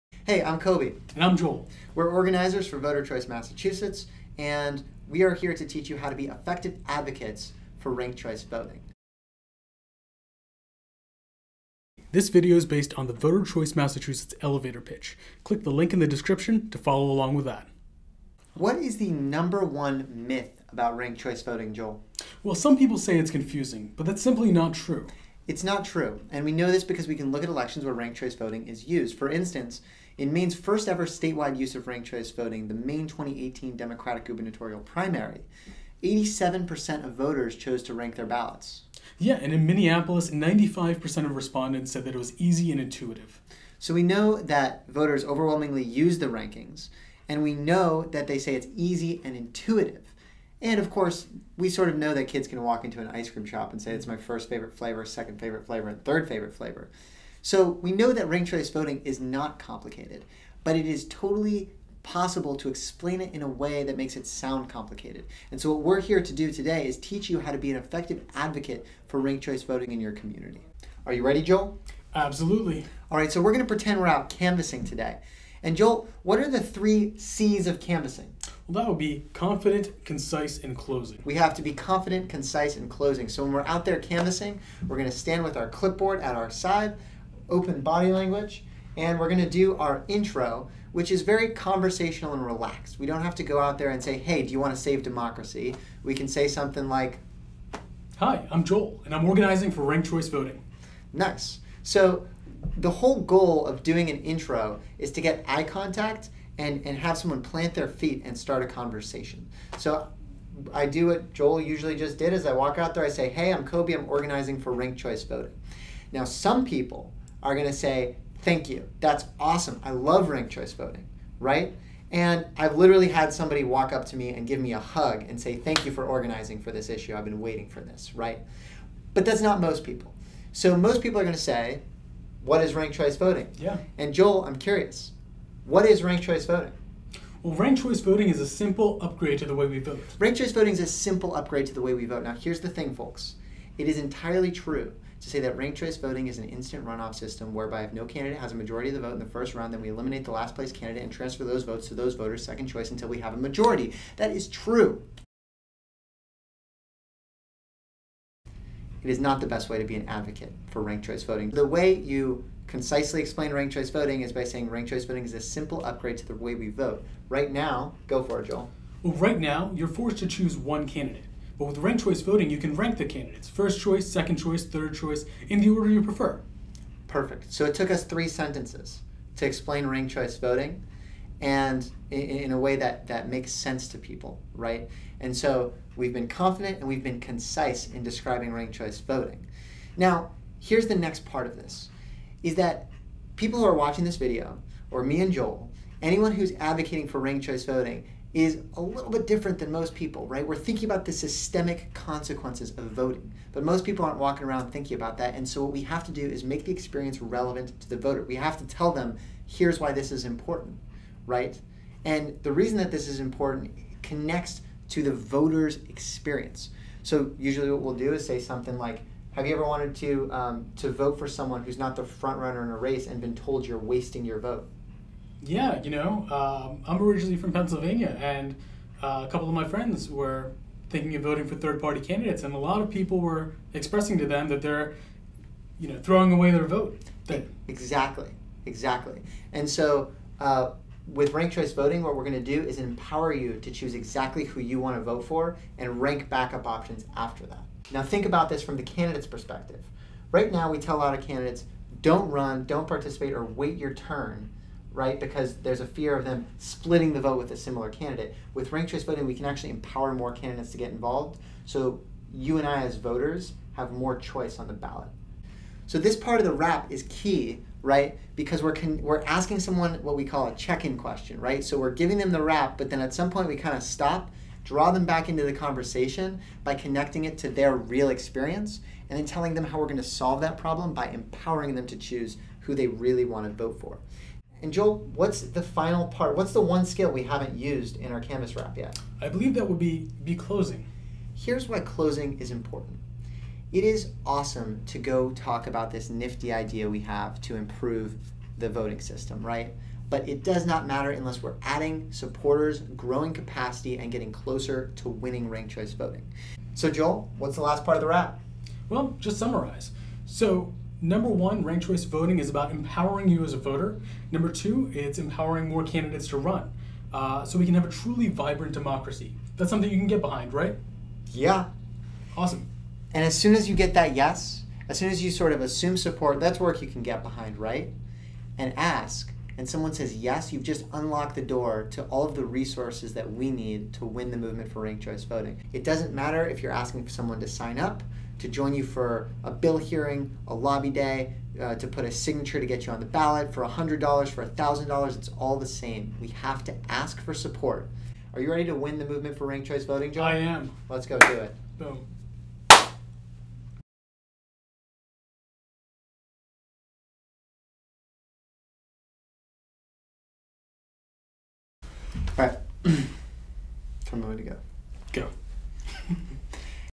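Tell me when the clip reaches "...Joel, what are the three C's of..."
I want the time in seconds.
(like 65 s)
75 s.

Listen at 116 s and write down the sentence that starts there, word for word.
Now, some people are going to say, thank you.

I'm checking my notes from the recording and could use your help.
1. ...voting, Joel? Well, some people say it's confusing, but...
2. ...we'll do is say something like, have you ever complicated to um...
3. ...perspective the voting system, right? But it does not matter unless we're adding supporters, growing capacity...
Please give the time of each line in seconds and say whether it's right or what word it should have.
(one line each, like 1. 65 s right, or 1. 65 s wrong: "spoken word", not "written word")
1. 21 s right
2. 217 s wrong: "wanted", not "complicated"
3. 297 s wrong: "improve", not "perspective".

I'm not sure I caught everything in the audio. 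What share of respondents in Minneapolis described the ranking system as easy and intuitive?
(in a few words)
95%.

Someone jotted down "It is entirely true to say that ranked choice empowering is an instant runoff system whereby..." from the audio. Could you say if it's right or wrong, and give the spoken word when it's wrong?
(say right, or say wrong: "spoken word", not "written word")
wrong: "voting", not "empowering".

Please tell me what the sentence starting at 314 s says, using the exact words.
Number two, it's empowering more candidates to run.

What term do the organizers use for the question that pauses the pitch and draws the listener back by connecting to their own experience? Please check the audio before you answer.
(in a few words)
Check-in question.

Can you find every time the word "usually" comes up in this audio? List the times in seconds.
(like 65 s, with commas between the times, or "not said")
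111 s, 217 s.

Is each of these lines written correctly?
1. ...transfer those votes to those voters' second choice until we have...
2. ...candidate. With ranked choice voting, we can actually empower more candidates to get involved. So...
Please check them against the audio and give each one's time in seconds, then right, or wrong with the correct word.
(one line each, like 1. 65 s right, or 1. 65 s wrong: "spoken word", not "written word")
1. 151 s right
2. 257 s right.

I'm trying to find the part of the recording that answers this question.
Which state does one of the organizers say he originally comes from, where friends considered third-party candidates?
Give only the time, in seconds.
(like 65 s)
227 s.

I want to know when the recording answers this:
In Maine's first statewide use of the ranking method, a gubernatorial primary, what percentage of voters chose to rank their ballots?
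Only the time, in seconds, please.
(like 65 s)
36 s.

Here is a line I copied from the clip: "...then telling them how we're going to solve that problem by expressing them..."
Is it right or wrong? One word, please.
wrong.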